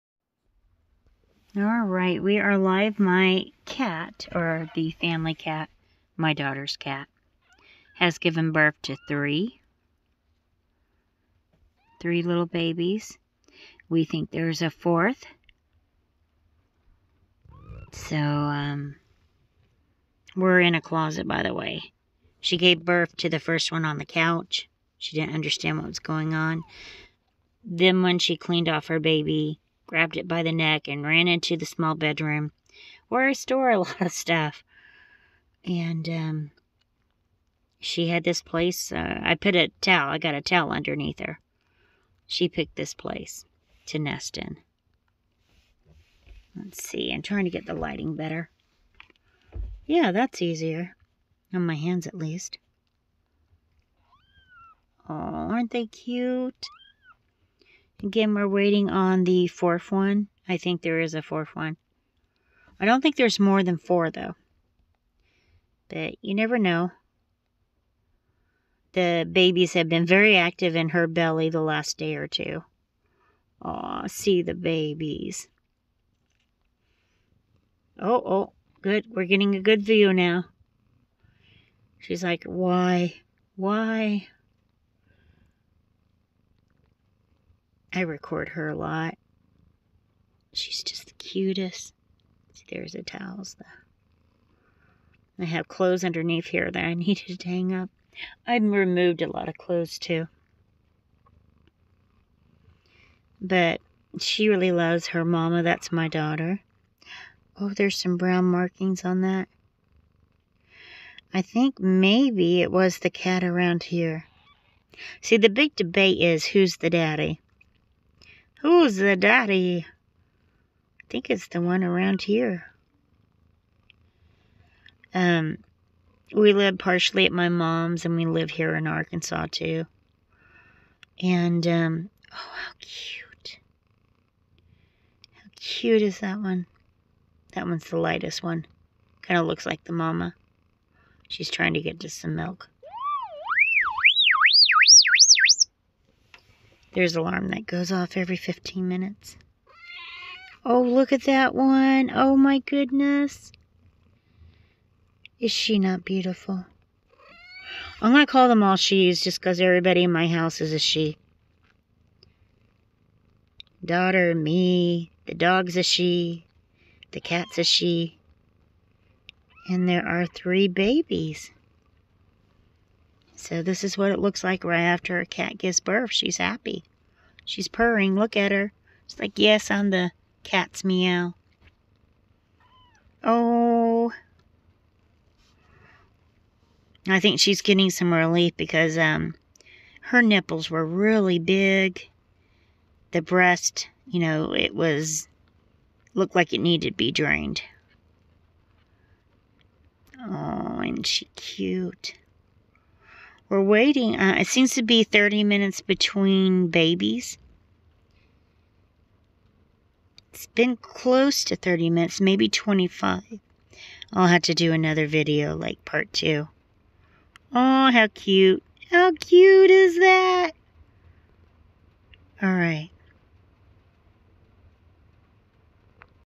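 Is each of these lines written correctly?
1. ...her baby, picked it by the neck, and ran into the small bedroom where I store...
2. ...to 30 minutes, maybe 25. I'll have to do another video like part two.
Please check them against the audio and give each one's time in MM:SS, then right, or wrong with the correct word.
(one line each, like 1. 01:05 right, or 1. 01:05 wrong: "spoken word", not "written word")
1. 00:28 wrong: "grabbed", not "picked"
2. 03:31 right.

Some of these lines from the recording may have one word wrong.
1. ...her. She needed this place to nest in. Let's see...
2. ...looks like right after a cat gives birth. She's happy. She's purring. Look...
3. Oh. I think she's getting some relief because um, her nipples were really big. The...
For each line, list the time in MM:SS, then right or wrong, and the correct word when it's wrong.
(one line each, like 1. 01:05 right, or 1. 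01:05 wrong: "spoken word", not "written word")
1. 00:41 wrong: "picked", not "needed"
2. 02:54 right
3. 03:03 right.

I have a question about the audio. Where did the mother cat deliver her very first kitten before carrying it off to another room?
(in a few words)
On the couch.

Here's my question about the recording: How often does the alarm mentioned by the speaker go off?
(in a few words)
Every 15 minutes.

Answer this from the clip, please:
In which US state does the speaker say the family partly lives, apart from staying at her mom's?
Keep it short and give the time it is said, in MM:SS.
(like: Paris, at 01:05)
Arkansas, at 02:08.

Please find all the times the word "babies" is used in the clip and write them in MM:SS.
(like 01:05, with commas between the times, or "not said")
00:12, 01:09, 01:14, 02:50, 03:26.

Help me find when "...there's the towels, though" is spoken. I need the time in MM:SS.
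01:32.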